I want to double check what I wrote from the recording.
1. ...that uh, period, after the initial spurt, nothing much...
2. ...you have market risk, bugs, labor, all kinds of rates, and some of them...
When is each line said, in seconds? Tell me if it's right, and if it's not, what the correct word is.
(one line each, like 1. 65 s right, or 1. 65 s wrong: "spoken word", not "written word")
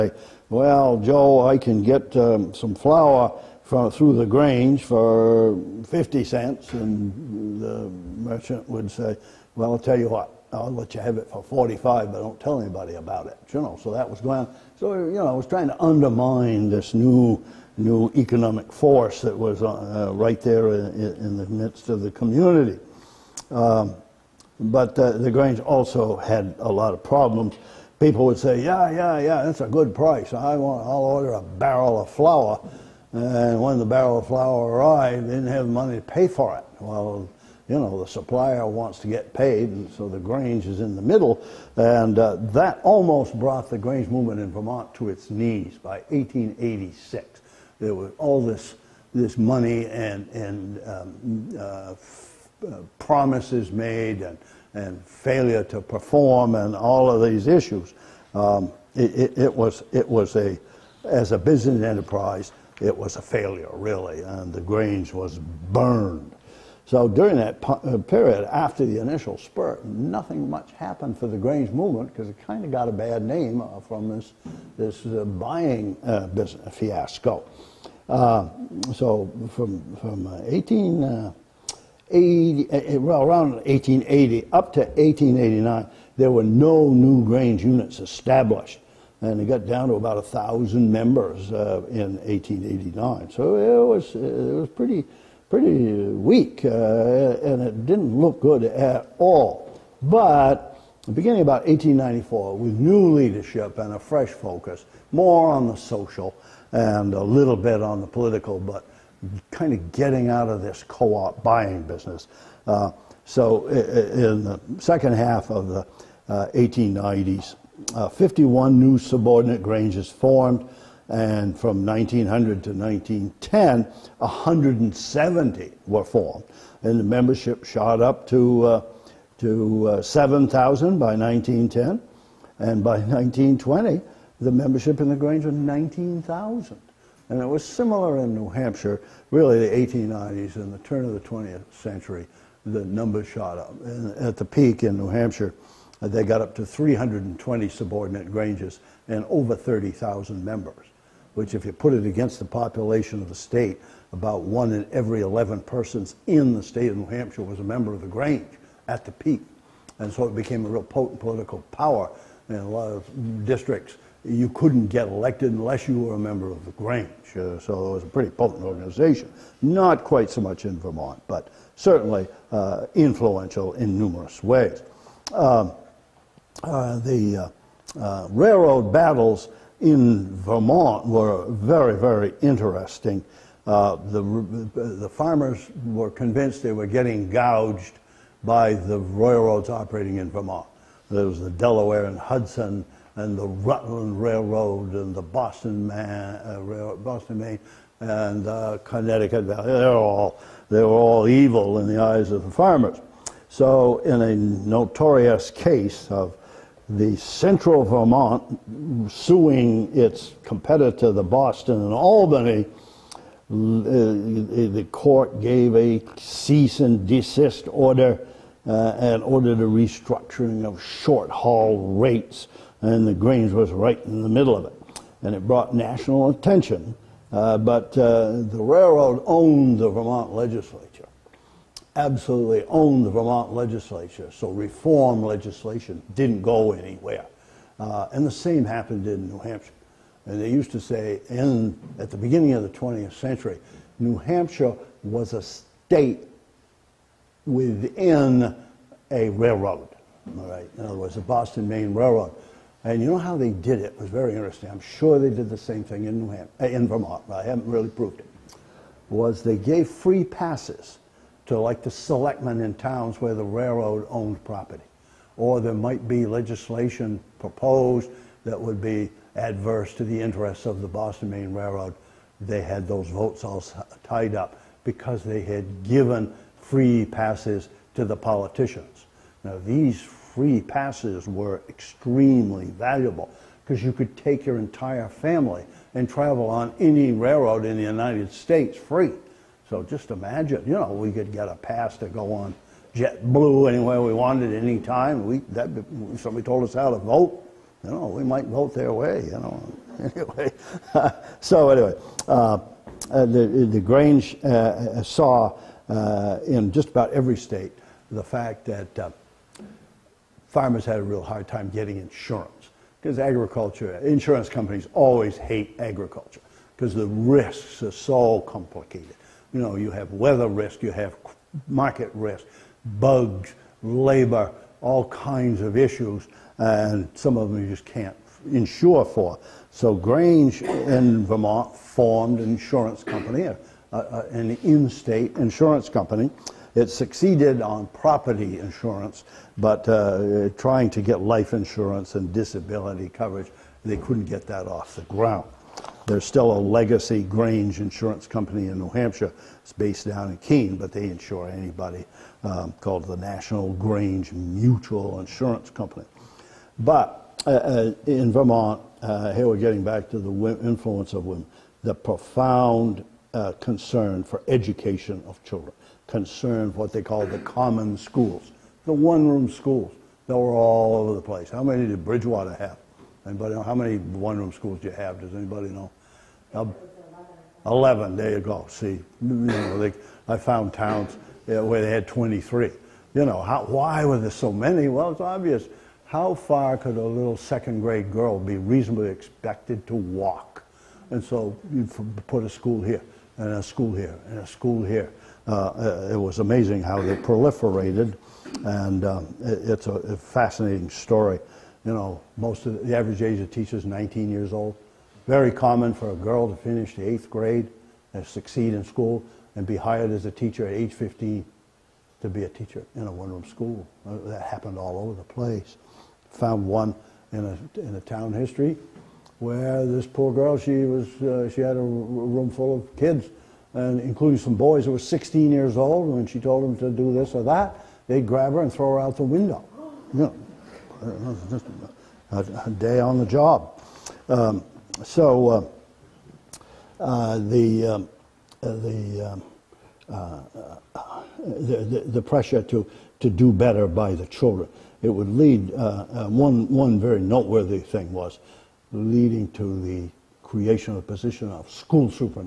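1. 67 s right
2. 320 s wrong: "issues", not "rates".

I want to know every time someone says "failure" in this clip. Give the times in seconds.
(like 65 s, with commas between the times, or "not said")
55 s, 63 s.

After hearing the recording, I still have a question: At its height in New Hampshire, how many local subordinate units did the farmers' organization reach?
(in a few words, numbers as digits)
320.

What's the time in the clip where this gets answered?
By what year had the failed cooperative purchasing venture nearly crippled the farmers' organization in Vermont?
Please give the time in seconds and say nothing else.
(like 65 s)
46 s.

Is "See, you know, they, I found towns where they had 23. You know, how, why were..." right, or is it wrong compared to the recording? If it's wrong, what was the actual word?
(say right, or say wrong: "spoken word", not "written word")
right.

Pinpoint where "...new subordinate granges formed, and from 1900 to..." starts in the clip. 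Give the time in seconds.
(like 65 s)
118 s.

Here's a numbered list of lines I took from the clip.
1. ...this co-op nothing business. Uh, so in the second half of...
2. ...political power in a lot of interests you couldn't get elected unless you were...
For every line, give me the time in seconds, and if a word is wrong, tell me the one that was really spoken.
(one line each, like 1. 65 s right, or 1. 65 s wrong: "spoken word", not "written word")
1. 110 s wrong: "buying", not "nothing"
2. 161 s wrong: "districts", not "interests".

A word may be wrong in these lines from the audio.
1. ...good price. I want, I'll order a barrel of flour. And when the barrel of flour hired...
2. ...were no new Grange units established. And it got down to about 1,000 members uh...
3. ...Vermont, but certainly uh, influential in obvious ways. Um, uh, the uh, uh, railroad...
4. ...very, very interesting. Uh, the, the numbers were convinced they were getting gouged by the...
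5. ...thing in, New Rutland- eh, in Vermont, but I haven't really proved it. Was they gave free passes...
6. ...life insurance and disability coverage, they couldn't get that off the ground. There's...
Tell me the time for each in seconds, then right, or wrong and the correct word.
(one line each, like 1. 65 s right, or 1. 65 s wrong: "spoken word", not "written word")
1. 29 s wrong: "arrived", not "hired"
2. 86 s right
3. 170 s wrong: "numerous", not "obvious"
4. 181 s wrong: "farmers", not "numbers"
5. 255 s wrong: "Ham", not "Rutland"
6. 341 s right.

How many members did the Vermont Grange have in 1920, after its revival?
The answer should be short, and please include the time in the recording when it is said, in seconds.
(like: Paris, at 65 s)
19,000, at 135 s.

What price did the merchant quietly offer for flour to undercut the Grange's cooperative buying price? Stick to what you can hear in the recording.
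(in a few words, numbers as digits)
45 cents.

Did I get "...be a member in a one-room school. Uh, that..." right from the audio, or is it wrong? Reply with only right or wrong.
wrong.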